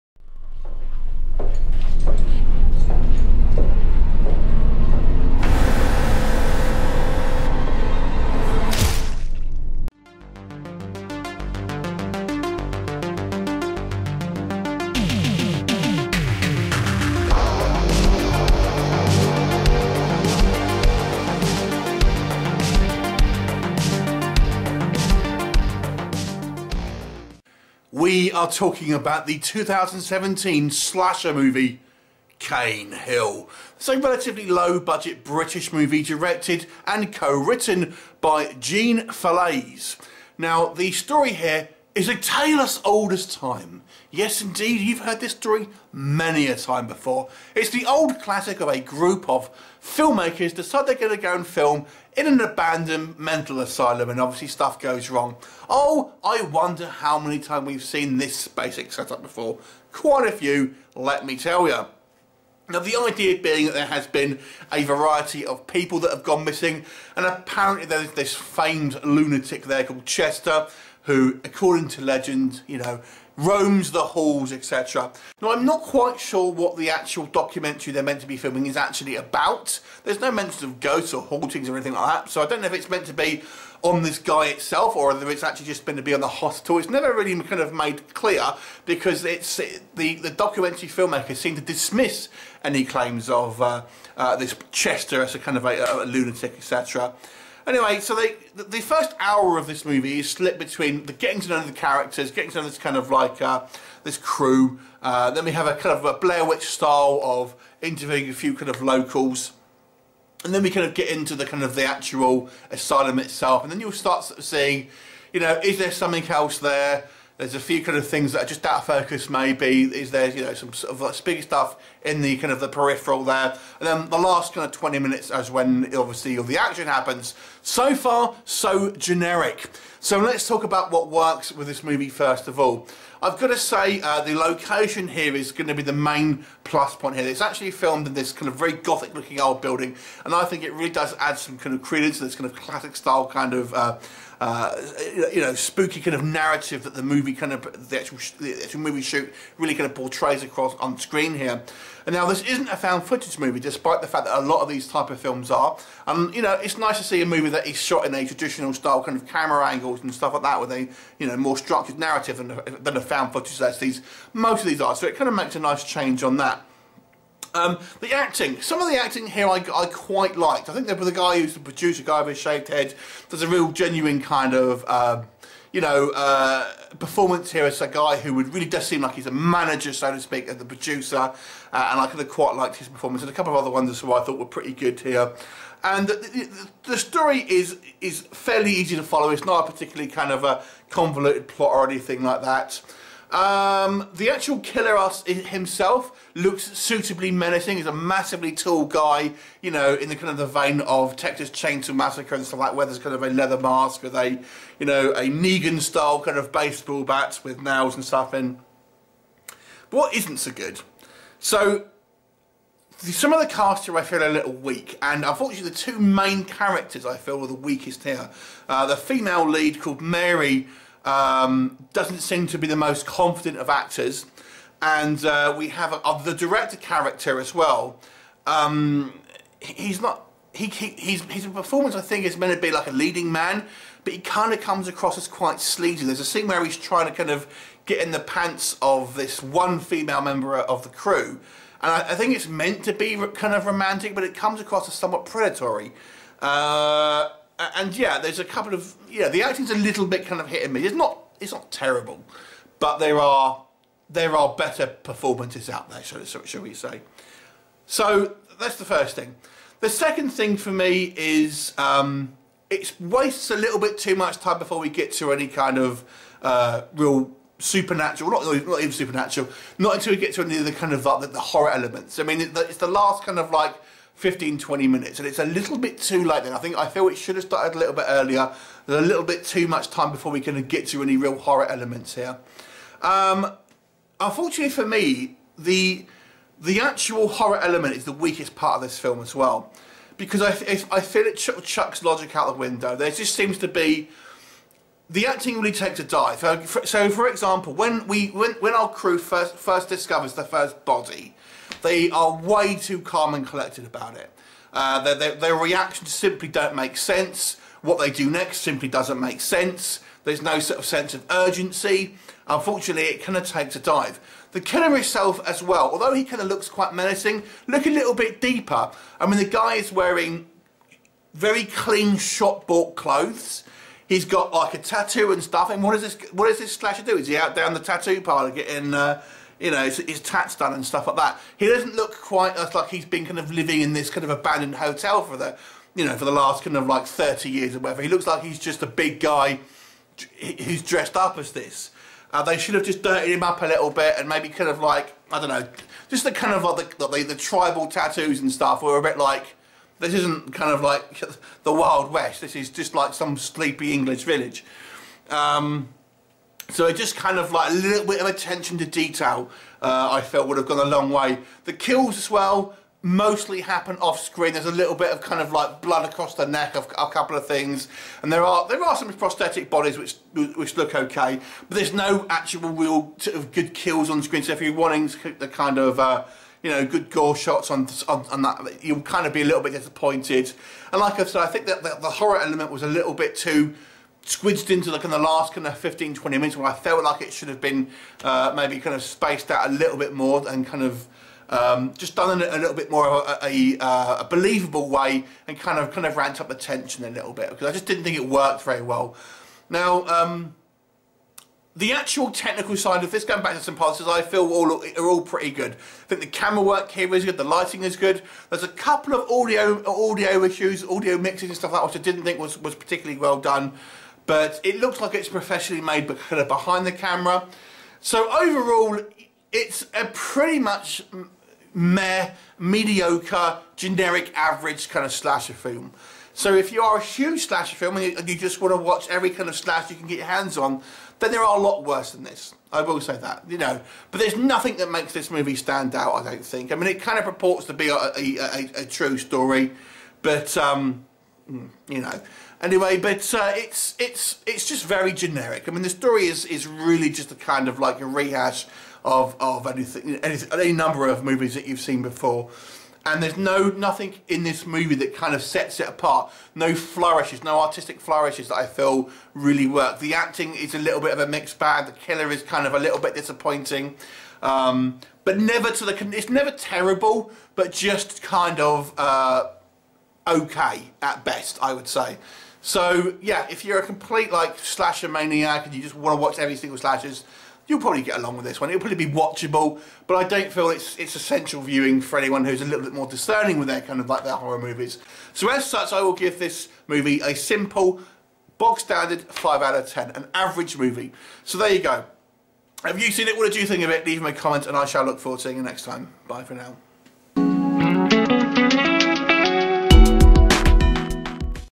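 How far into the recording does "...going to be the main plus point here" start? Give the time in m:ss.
2:15.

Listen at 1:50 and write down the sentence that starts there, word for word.
And then we kind of get into the kind of the actual asylum itself.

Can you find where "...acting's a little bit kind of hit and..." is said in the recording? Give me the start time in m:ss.
4:09.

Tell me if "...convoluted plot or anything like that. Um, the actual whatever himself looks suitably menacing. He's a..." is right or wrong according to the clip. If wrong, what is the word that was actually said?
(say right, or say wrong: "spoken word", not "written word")
wrong: "killer", not "whatever".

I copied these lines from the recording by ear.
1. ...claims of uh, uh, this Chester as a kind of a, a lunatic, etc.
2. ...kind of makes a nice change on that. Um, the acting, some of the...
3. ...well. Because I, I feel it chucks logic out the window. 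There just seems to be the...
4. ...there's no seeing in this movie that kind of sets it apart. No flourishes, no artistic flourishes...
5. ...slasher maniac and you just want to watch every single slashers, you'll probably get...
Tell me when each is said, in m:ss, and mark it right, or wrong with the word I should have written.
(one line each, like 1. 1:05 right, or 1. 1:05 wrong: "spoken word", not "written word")
1. 1:32 right
2. 2:45 right
3. 4:49 right
4. 7:33 wrong: "nothing", not "seeing"
5. 7:54 right.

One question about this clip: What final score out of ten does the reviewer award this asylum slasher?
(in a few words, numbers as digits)
5.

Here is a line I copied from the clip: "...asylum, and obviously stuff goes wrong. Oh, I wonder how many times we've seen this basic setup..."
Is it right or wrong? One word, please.
right.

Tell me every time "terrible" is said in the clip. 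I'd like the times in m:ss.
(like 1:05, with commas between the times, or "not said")
4:11, 7:46.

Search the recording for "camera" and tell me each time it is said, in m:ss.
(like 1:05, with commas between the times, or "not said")
2:39, 6:46, 6:56.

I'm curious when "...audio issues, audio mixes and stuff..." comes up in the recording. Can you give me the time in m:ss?
6:49.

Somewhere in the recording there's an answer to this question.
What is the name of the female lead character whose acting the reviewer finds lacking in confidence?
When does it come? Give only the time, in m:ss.
3:40.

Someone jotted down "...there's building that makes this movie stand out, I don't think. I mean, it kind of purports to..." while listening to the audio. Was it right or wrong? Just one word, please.
wrong.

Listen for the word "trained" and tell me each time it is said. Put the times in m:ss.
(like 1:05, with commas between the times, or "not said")
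not said.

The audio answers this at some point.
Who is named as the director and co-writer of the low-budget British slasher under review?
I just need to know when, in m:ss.
0:38.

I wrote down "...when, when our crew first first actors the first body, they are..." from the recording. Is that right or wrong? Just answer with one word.
wrong.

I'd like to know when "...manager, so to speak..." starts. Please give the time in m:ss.
2:59.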